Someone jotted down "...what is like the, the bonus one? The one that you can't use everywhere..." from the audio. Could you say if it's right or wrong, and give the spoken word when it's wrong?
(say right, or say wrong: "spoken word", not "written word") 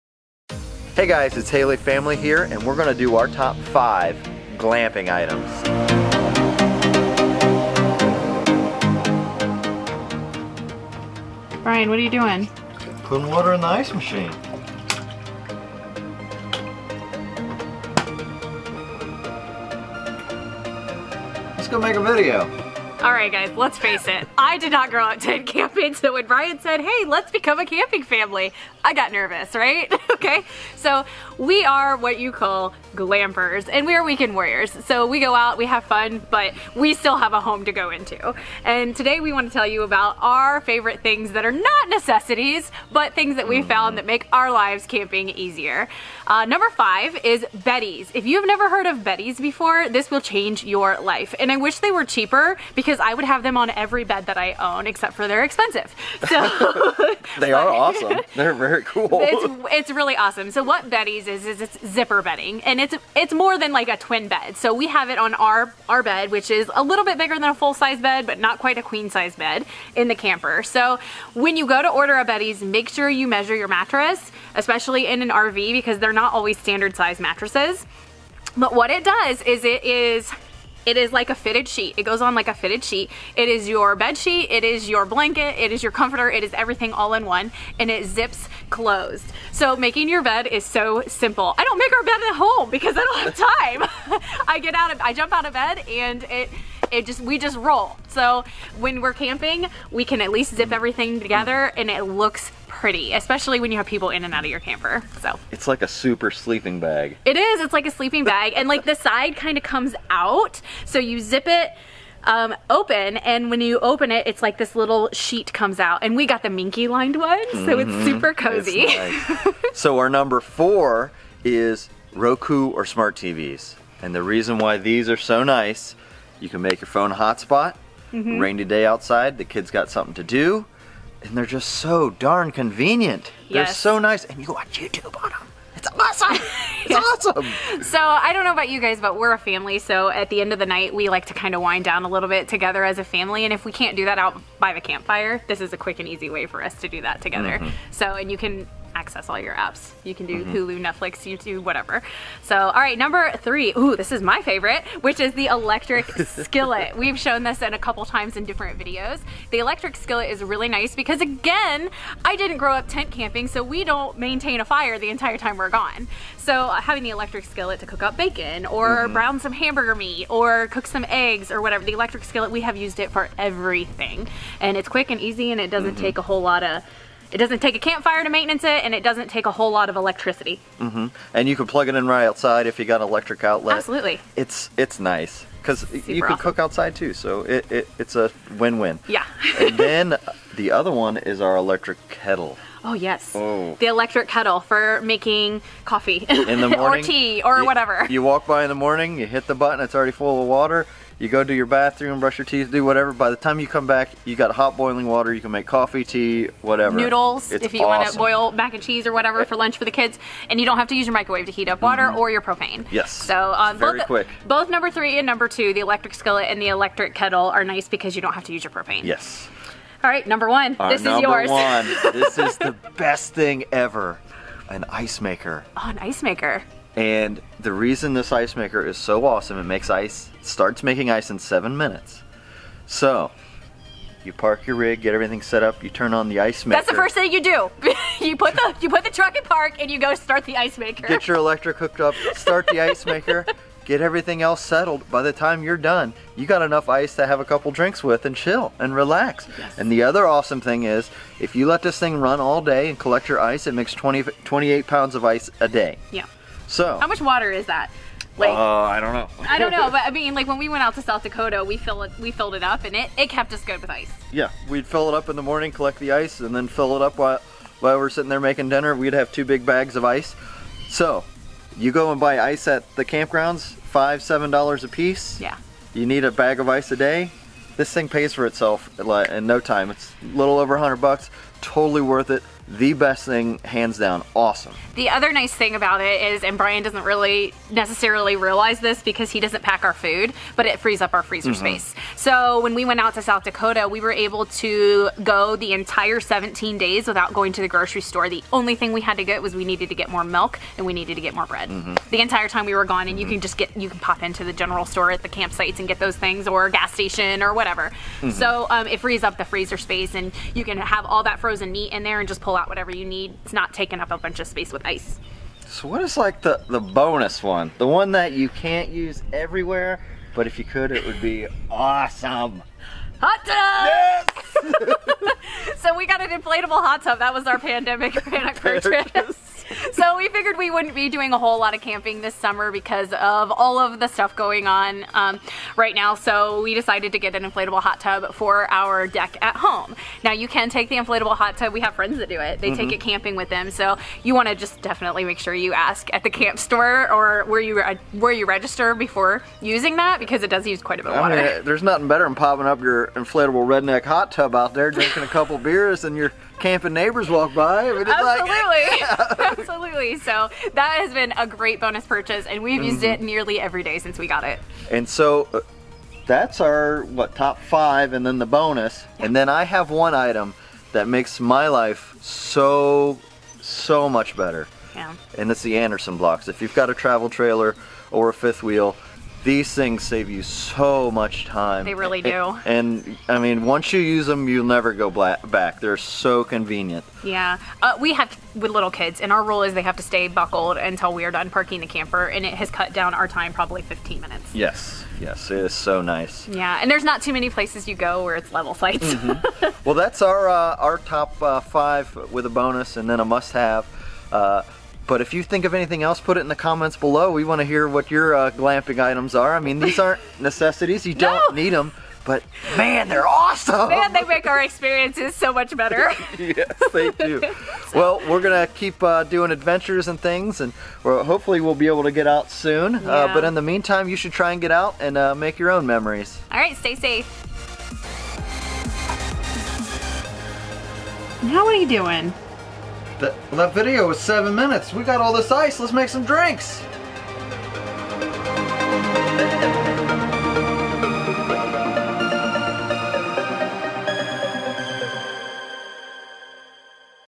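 right.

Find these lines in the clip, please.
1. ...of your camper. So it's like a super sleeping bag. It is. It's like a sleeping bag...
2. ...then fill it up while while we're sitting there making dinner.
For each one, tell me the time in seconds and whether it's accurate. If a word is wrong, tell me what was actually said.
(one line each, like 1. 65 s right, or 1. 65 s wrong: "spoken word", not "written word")
1. 104 s right
2. 266 s right.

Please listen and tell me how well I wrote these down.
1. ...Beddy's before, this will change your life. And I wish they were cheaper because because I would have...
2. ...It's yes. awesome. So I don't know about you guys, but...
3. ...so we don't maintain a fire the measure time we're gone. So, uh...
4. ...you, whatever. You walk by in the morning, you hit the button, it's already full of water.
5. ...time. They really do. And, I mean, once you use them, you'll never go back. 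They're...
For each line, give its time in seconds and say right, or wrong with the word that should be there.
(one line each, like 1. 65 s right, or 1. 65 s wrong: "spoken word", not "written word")
1. 49 s right
2. 136 s right
3. 163 s wrong: "entire", not "measure"
4. 197 s right
5. 381 s right.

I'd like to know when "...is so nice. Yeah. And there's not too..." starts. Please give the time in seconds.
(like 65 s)
395 s.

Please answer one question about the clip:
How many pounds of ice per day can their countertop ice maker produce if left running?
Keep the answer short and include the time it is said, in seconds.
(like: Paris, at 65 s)
28, at 254 s.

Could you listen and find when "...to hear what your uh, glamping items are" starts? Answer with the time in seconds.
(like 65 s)
407 s.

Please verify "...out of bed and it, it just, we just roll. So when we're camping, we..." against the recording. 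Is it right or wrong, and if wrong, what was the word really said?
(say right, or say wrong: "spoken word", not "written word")
right.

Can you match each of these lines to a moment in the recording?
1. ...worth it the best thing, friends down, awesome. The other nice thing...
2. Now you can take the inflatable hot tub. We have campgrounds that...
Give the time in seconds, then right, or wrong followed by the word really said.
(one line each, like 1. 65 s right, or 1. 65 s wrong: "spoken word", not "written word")
1. 282 s wrong: "hands", not "friends"
2. 340 s wrong: "friends", not "campgrounds".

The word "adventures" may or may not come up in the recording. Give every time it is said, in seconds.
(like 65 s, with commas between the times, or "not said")
419 s.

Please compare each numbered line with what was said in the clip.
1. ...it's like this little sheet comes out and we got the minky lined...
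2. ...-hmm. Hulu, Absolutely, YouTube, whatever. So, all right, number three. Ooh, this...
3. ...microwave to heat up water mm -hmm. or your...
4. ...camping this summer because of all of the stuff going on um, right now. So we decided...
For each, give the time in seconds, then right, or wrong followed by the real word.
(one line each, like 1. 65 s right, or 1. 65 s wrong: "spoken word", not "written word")
1. 114 s right
2. 150 s wrong: "Netflix", not "Absolutely"
3. 211 s right
4. 331 s right.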